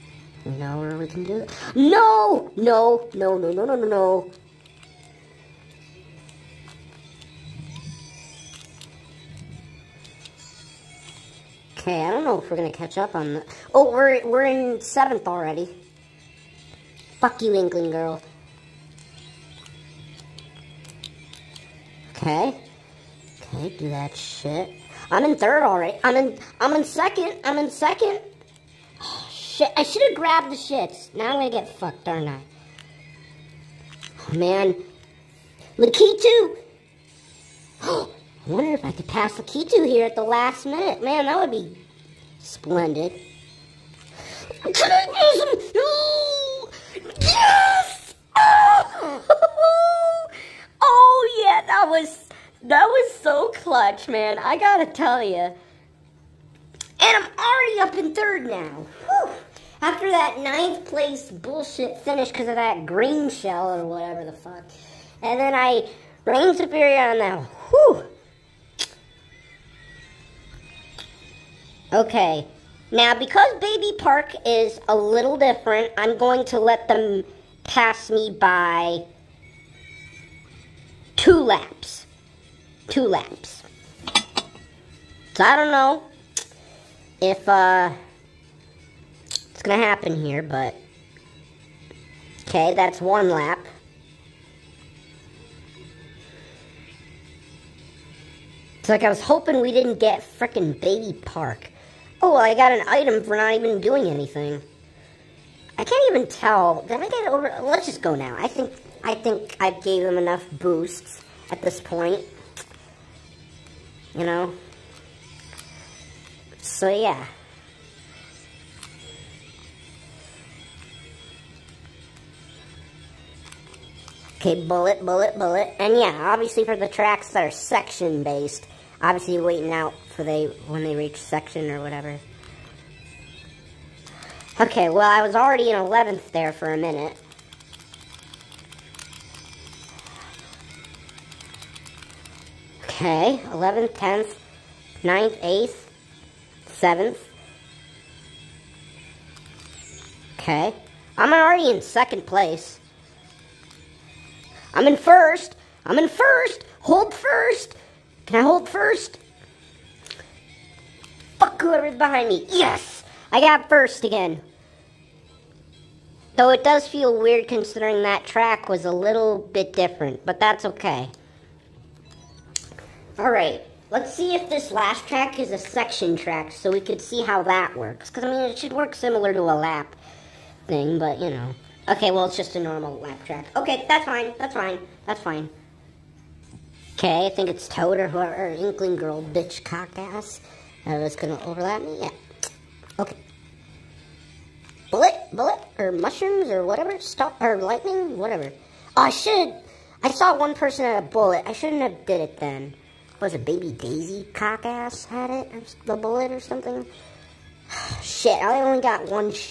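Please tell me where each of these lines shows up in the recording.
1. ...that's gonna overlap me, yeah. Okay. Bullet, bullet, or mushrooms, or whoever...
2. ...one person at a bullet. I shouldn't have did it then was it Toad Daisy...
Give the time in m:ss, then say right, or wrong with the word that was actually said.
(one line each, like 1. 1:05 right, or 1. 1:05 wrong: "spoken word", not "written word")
1. 3:10 wrong: "whatever", not "whoever"
2. 3:20 wrong: "Baby", not "Toad".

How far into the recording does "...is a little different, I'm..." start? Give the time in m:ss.
1:14.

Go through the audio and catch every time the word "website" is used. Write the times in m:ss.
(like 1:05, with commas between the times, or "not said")
not said.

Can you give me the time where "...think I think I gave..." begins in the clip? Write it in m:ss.
1:48.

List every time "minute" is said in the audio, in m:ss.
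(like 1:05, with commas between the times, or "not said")
0:40, 2:16.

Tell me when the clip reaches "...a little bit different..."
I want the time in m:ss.
2:48.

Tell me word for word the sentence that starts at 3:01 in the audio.
Okay, well, it's just a normal lap track.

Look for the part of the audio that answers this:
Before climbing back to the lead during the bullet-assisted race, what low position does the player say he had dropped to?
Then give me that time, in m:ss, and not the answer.
2:15.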